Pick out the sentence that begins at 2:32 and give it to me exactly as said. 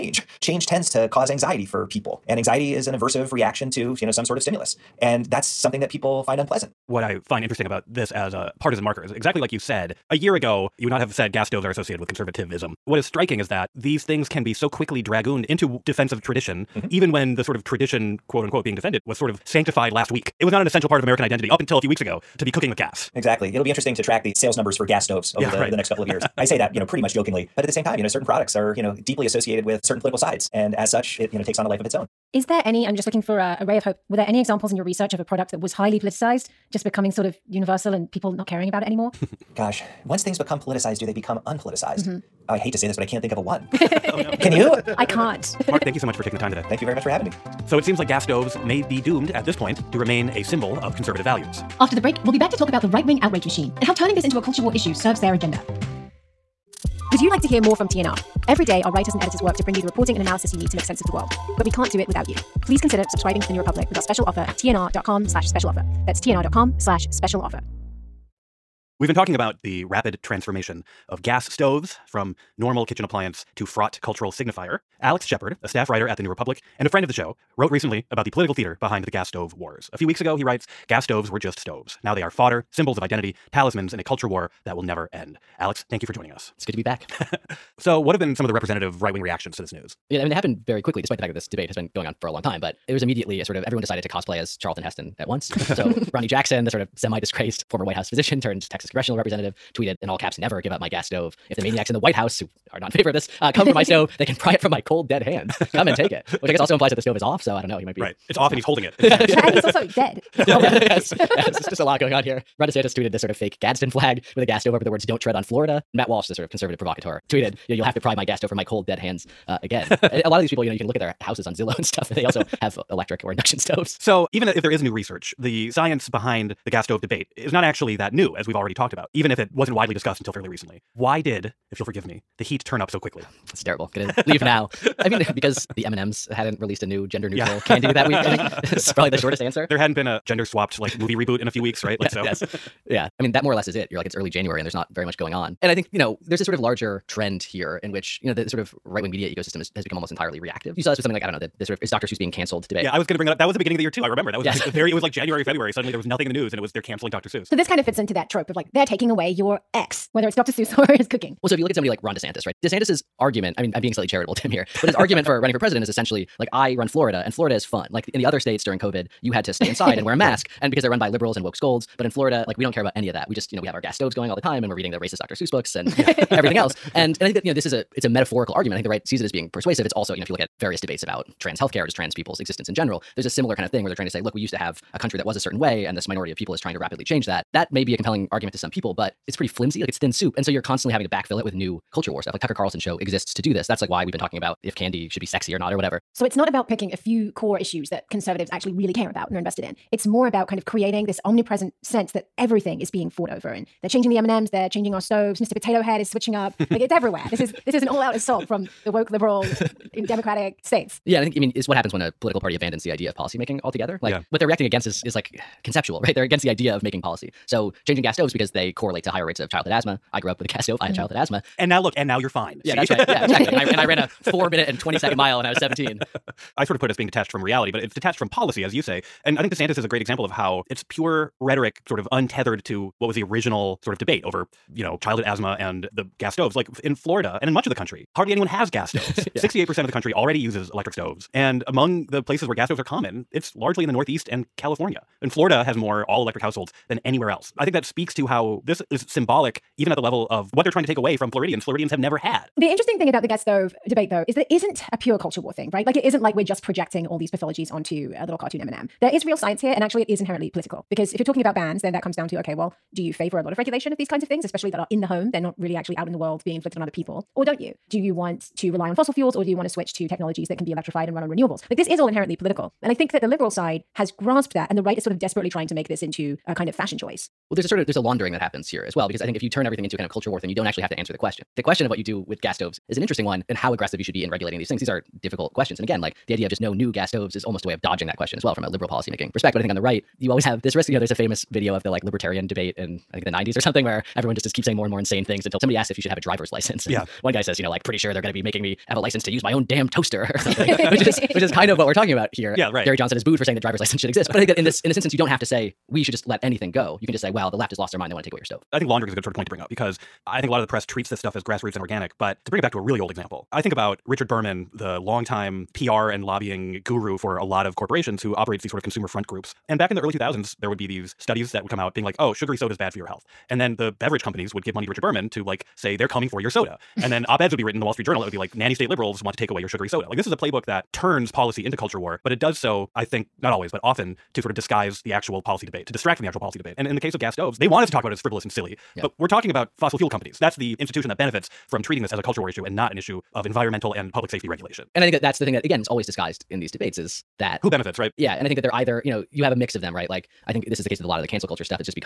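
Yeah, I was going to bring that up.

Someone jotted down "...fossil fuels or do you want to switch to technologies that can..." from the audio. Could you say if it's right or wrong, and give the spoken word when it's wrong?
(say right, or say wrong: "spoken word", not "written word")
right.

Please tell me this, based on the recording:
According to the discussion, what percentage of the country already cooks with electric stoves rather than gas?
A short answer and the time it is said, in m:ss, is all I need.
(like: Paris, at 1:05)
68%, at 3:59.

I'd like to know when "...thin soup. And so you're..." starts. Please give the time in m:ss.
3:09.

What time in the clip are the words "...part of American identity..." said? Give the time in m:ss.
0:20.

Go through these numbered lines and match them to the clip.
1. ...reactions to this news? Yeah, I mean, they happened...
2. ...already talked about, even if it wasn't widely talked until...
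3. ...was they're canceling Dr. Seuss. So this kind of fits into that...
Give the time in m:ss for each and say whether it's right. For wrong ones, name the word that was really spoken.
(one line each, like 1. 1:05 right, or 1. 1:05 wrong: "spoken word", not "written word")
1. 1:29 right
2. 2:08 wrong: "discussed", not "talked"
3. 2:36 right.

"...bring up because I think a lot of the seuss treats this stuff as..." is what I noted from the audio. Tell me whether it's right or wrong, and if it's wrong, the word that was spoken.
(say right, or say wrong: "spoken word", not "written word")
wrong: "press", not "seuss".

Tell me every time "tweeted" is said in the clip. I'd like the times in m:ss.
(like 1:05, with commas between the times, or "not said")
1:39, 1:52, 1:57.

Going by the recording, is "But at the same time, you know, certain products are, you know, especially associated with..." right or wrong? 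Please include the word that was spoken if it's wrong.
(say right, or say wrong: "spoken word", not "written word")
wrong: "deeply", not "especially".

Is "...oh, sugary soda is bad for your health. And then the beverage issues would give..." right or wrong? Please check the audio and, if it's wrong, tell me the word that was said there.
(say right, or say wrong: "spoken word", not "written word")
wrong: "companies", not "issues".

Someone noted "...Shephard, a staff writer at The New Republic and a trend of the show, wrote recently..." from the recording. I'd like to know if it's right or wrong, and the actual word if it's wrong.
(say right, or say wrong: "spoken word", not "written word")
wrong: "friend", not "trend".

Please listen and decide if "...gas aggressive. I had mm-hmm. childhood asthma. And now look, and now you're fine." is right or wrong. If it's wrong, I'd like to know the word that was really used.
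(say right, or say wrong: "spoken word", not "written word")
wrong: "stove", not "aggressive".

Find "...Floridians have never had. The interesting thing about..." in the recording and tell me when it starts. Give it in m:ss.
4:11.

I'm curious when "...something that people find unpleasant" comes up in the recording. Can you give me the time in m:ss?
0:05.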